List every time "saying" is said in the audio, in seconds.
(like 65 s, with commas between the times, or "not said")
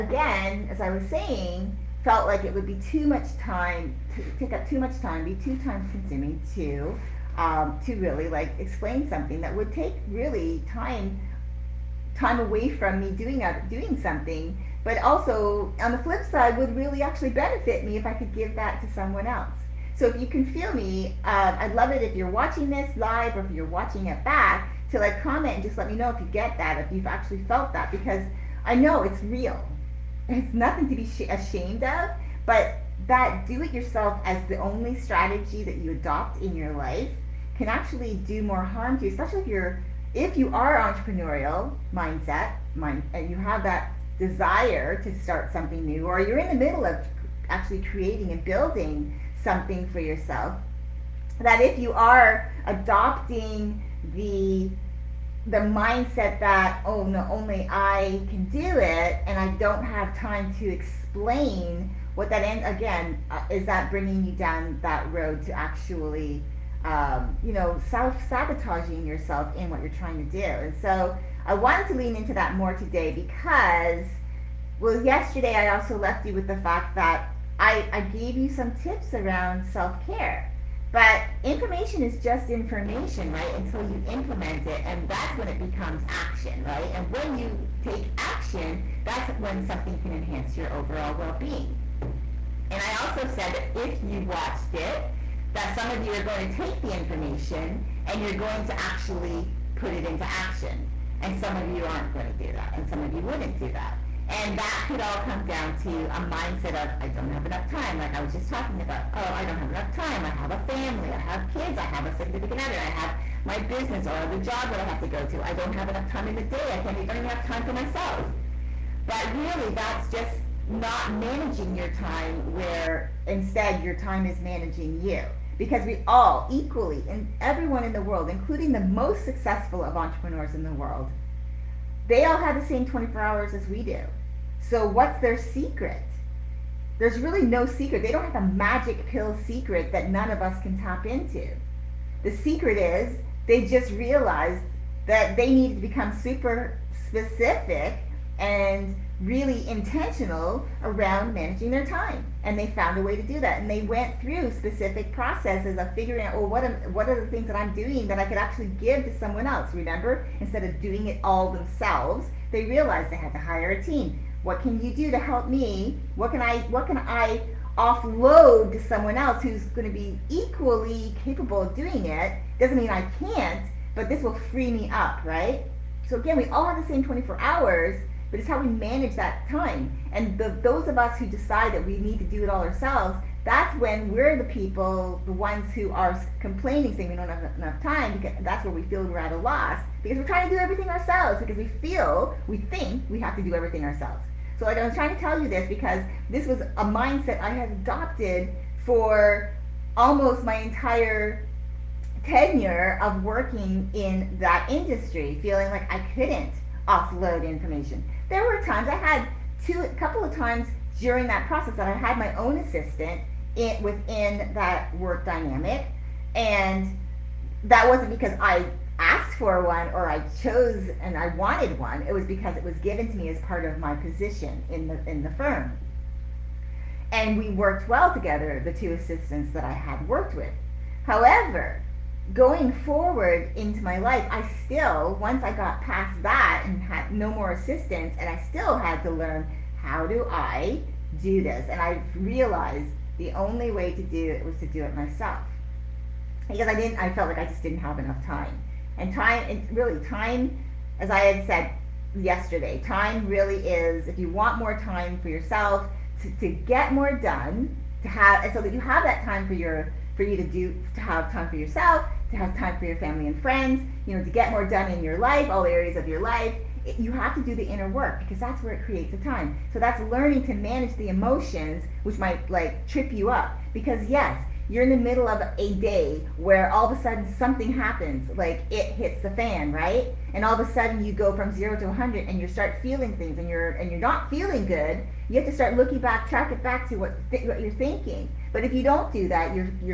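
1 s, 186 s.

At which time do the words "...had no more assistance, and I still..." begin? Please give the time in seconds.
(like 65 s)
236 s.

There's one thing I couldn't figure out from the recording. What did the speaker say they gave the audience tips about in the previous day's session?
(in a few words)
self care.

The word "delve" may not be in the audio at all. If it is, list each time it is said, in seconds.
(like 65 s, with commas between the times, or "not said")
not said.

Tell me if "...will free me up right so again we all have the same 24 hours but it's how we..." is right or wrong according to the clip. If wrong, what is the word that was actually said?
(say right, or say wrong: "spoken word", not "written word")
right.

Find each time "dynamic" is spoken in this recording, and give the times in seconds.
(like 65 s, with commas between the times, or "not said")
215 s.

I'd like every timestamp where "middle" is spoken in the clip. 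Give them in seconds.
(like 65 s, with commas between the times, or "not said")
46 s, 274 s.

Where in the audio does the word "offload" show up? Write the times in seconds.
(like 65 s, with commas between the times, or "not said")
167 s, 206 s.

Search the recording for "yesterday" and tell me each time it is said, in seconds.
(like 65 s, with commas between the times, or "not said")
75 s, 252 s.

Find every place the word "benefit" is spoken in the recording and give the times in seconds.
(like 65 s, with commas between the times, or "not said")
17 s.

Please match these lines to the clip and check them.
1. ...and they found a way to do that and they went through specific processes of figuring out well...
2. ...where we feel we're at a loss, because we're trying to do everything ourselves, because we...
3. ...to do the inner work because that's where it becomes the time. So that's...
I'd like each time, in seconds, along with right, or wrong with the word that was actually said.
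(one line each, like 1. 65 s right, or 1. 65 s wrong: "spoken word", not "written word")
1. 152 s right
2. 188 s right
3. 267 s wrong: "creates", not "becomes".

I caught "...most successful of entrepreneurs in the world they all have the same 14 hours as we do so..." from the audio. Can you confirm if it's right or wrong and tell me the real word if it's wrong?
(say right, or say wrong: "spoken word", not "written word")
wrong: "24", not "14".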